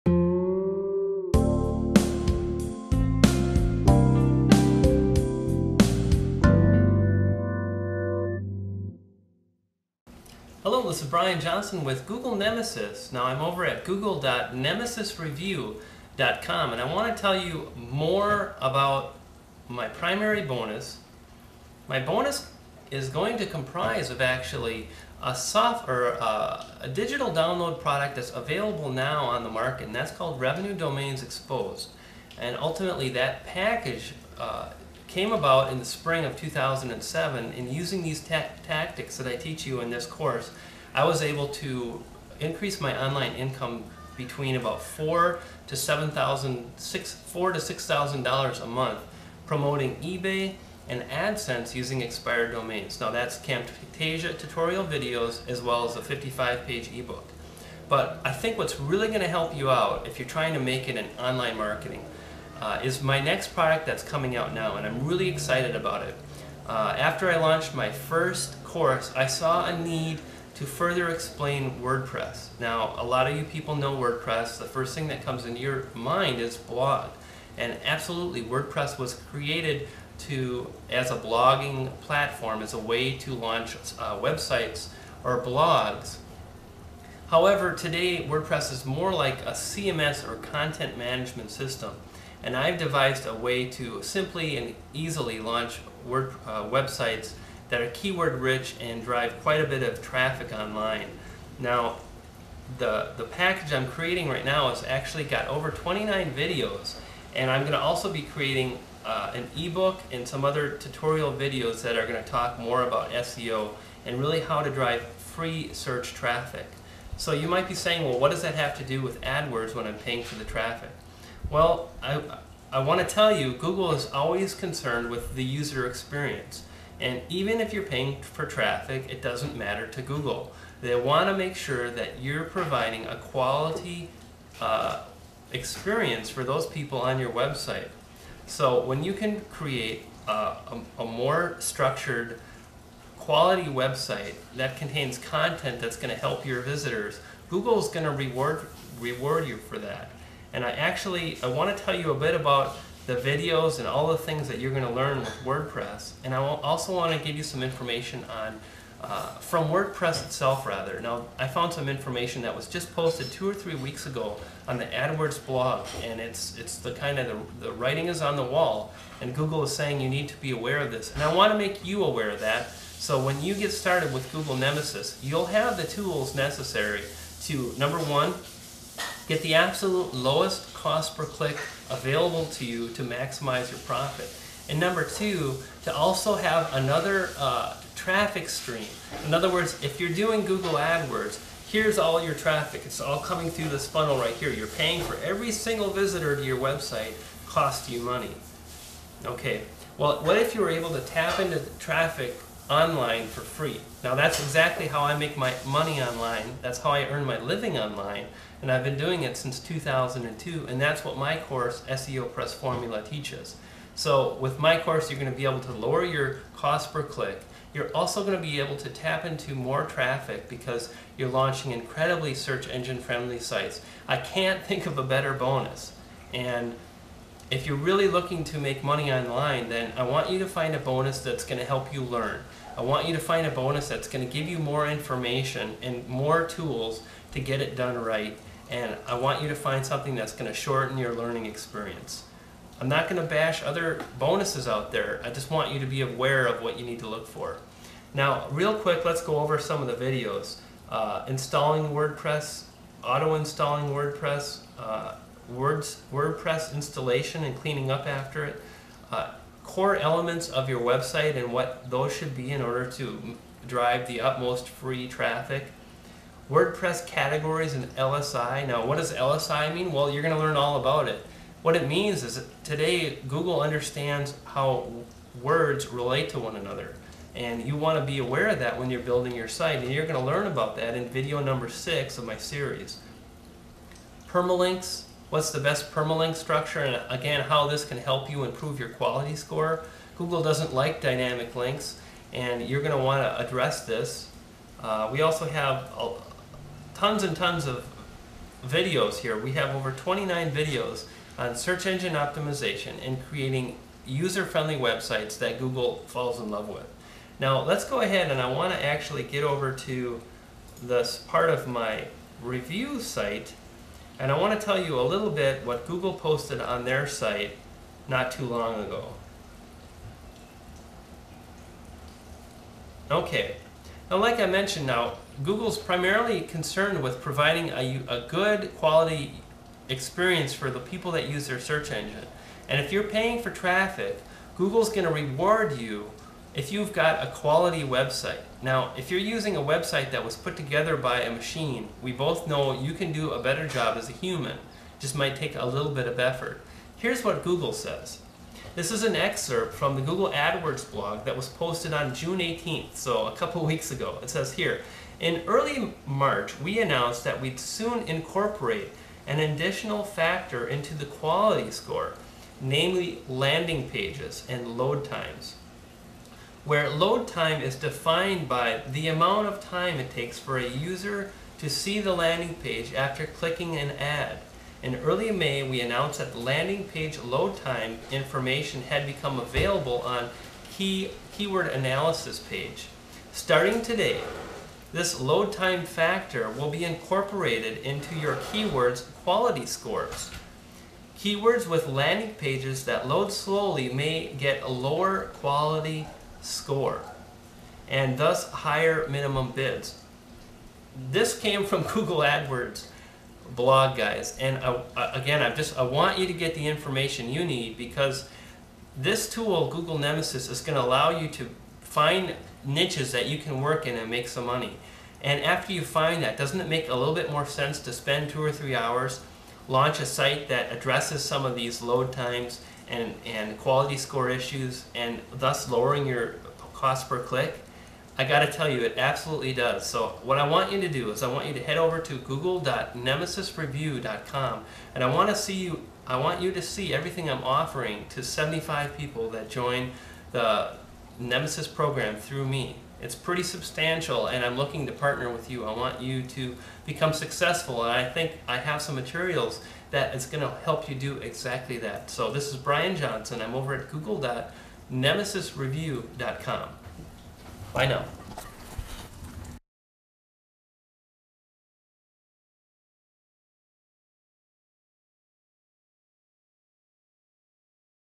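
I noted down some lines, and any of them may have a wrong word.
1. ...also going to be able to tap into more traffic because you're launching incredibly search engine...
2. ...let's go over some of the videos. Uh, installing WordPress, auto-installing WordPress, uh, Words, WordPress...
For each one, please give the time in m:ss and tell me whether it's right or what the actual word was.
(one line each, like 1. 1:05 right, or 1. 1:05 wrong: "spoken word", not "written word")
1. 3:37 right
2. 4:09 right.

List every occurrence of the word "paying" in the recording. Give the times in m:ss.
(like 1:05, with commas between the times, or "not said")
1:59, 2:07, 3:14, 5:33.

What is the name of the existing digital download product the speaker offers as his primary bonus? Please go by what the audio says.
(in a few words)
Revenue Domains Exposed.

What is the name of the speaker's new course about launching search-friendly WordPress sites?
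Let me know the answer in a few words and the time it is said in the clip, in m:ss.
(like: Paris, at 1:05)
SEO Press Formula, at 3:31.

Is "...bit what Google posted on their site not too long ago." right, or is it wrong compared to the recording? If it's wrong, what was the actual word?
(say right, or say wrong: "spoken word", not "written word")
right.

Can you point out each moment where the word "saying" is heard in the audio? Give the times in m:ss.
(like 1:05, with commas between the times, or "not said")
1:57, 2:49.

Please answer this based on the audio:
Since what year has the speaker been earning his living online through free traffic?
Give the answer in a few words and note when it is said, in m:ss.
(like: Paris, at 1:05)
2002, at 3:29.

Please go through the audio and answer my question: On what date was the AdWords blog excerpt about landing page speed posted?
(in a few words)
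June 18th.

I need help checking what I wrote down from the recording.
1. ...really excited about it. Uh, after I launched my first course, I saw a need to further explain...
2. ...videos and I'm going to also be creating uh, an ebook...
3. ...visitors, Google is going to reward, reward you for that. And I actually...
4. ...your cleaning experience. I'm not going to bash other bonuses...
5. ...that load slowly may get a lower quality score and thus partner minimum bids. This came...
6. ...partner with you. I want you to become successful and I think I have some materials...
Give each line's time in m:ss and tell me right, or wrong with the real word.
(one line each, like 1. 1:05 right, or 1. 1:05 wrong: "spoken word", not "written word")
1. 1:05 right
2. 1:46 right
3. 2:26 right
4. 4:00 wrong: "learning", not "cleaning"
5. 6:32 wrong: "higher", not "partner"
6. 7:24 right.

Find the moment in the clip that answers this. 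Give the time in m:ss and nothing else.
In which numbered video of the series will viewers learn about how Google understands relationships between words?
4:41.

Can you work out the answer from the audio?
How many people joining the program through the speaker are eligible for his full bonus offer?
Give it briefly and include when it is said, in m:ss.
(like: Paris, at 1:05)
75, at 7:18.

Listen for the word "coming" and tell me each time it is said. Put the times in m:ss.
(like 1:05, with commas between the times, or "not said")
1:04, 3:13.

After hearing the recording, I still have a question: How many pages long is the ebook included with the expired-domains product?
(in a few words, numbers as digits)
55.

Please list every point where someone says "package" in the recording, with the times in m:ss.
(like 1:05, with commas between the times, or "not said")
0:33, 1:43.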